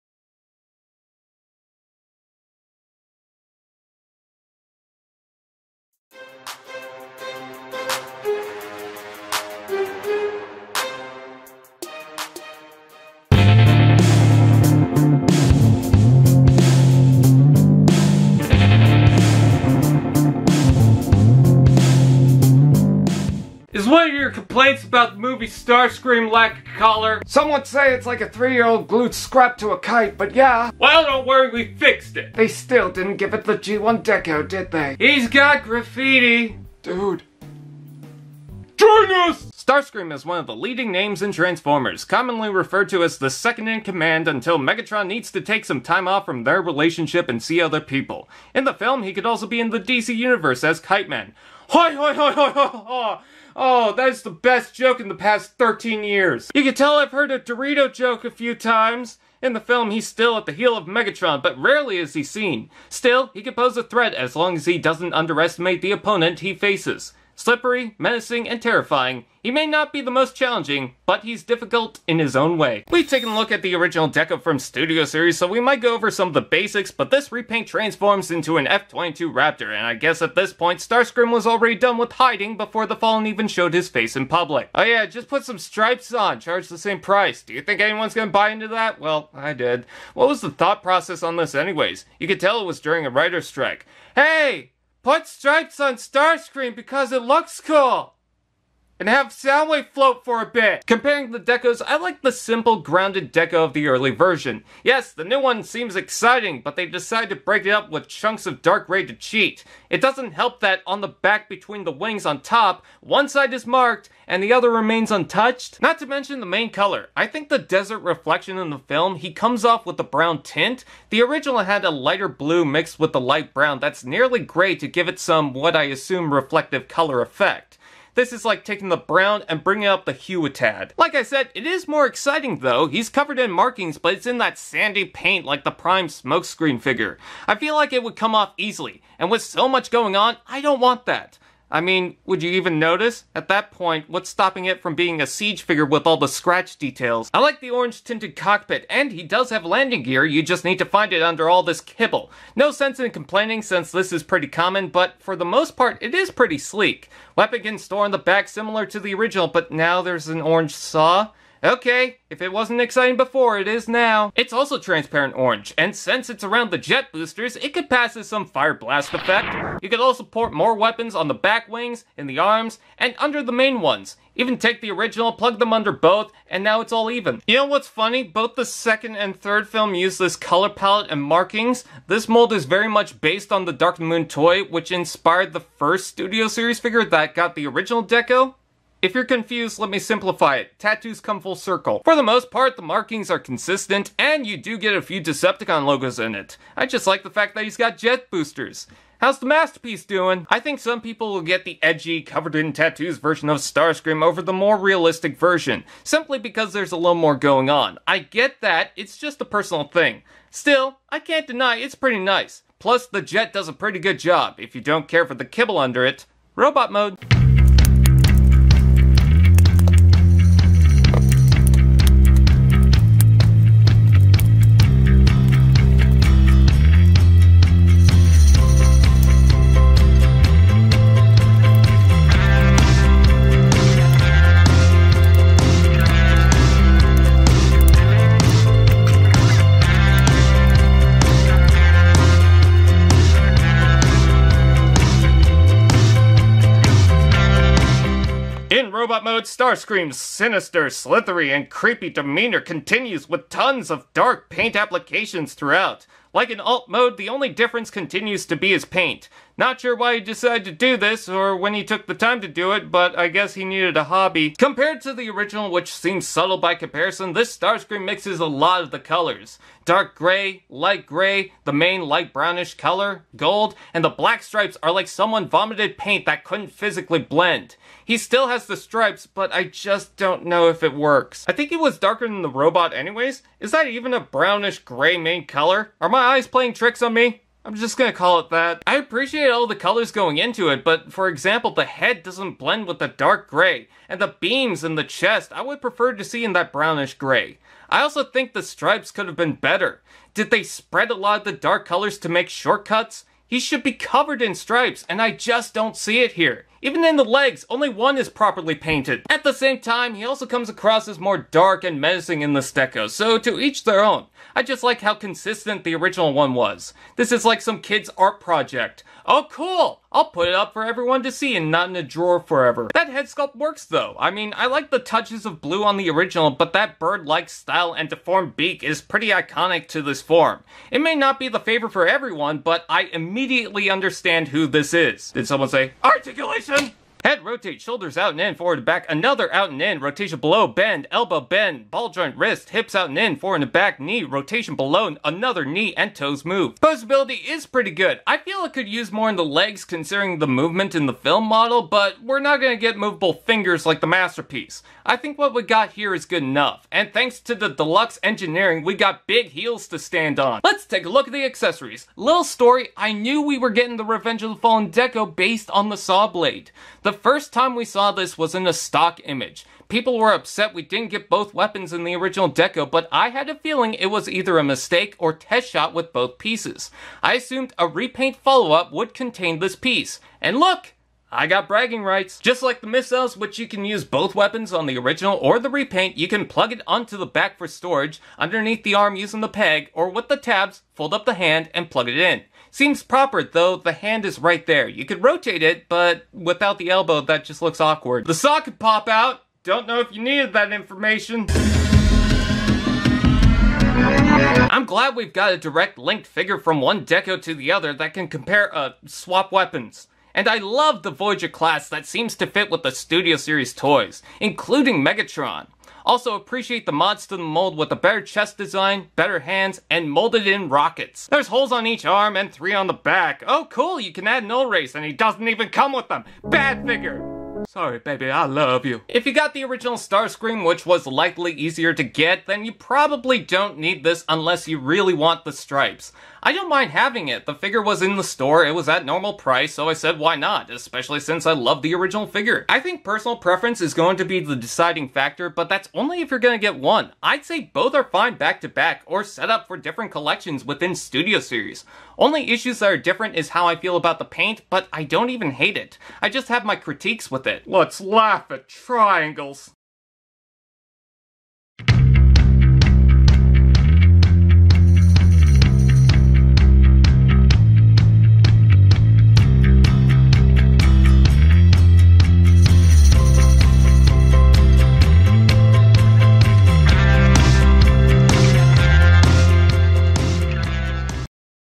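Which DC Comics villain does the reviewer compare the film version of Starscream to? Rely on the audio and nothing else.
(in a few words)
Kite Man.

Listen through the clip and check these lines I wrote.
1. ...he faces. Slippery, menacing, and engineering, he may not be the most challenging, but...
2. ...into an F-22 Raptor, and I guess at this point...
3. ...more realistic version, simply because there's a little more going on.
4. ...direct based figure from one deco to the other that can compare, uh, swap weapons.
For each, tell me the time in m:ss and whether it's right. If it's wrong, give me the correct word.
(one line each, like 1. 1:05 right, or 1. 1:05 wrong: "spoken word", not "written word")
1. 1:06 wrong: "terrifying", not "engineering"
2. 1:18 right
3. 3:24 right
4. 6:45 wrong: "linked", not "based".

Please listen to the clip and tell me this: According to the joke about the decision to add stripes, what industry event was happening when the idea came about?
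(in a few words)
writer's strike.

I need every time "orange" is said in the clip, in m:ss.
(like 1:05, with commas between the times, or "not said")
2:27, 2:40, 2:45.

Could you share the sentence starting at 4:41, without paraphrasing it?
I think it was darker than the robot anyways.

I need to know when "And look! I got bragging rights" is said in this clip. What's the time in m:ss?
6:20.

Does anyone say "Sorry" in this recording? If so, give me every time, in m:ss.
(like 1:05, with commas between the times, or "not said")
7:07.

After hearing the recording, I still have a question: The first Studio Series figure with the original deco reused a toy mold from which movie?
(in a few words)
Dark Moon.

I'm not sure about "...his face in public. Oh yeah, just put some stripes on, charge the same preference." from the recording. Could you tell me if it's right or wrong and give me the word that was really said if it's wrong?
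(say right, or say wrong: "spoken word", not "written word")
wrong: "price", not "preference".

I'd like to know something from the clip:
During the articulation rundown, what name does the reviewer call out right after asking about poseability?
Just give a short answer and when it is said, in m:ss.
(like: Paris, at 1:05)
Jason, at 5:36.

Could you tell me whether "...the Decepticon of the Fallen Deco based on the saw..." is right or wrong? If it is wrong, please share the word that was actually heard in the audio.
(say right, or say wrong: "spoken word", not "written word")
wrong: "Revenge", not "Decepticon".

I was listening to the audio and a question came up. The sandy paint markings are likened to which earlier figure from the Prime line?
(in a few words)
Smokescreen.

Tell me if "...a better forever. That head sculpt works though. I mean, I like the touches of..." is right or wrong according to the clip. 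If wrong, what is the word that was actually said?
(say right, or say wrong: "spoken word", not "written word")
wrong: "drawer", not "better".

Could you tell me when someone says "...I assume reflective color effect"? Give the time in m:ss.
2:05.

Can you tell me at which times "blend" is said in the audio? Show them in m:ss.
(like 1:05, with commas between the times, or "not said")
4:37, 4:52.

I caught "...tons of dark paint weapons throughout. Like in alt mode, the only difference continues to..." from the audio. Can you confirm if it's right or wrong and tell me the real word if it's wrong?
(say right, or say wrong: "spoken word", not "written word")
wrong: "applications", not "weapons".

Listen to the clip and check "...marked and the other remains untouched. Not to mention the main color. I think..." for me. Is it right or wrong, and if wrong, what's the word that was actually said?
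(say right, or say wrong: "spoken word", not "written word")
right.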